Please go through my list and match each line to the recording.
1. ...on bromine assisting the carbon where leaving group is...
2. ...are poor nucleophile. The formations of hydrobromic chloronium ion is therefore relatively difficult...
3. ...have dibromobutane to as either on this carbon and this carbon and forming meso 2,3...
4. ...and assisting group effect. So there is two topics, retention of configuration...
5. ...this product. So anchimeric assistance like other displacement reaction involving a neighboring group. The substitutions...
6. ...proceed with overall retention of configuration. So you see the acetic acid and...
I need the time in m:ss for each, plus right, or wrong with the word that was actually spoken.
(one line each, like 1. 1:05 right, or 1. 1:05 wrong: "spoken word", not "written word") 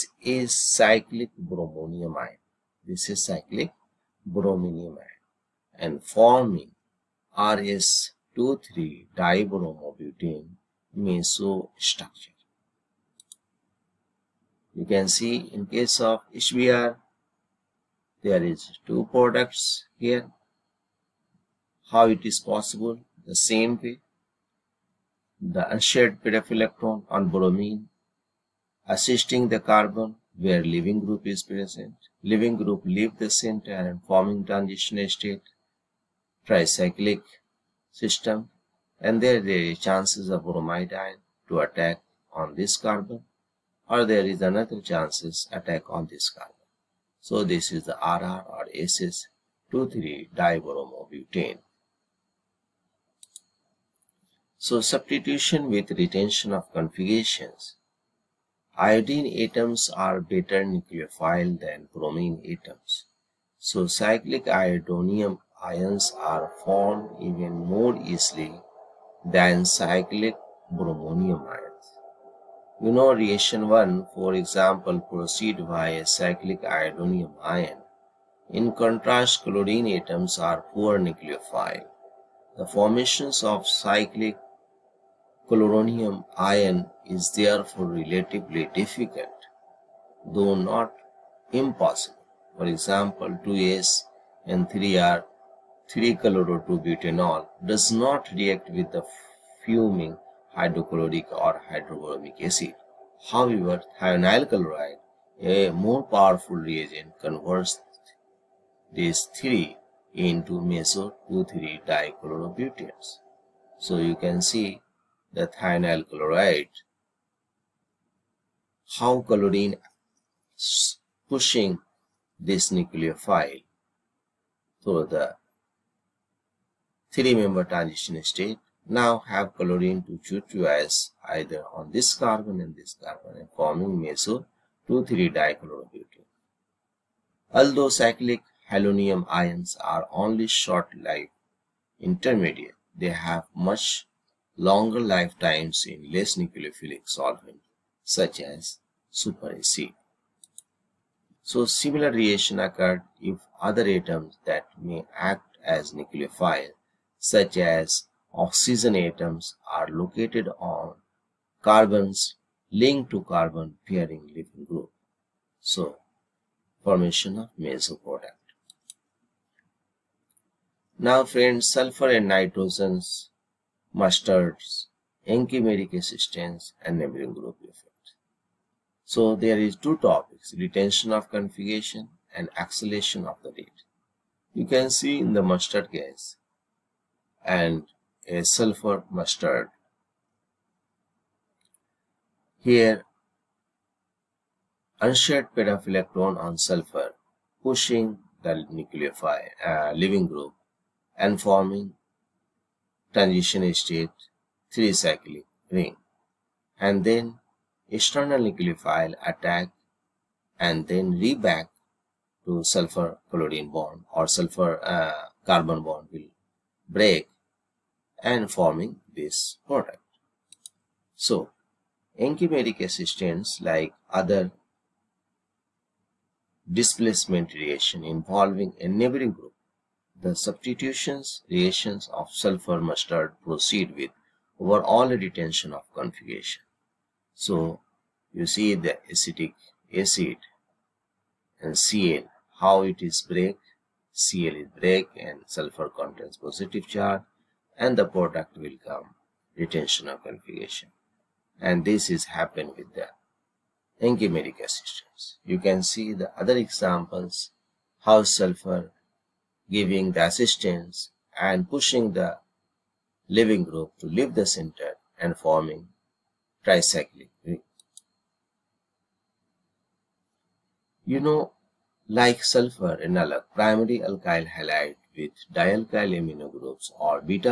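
1. 0:27 right
2. 1:20 wrong: "cyclic", not "hydrobromic"
3. 2:09 wrong: "chlorine", not "dibromobutane"
4. 2:56 wrong: "neighboring", not "assisting"
5. 3:39 right
6. 3:53 right.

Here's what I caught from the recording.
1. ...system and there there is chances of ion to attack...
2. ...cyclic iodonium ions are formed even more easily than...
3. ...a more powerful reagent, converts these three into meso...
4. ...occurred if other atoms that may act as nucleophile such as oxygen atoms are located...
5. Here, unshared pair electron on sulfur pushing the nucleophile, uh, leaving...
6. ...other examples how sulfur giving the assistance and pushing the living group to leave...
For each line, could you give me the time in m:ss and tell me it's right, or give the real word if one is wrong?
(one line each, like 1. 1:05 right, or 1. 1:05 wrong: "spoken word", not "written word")
1. 0:38 right
2. 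1:03 right
3. 1:45 right
4. 2:32 right
5. 3:12 right
6. 4:16 right.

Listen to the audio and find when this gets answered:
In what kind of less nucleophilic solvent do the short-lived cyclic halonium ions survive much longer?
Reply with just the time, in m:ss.
2:29.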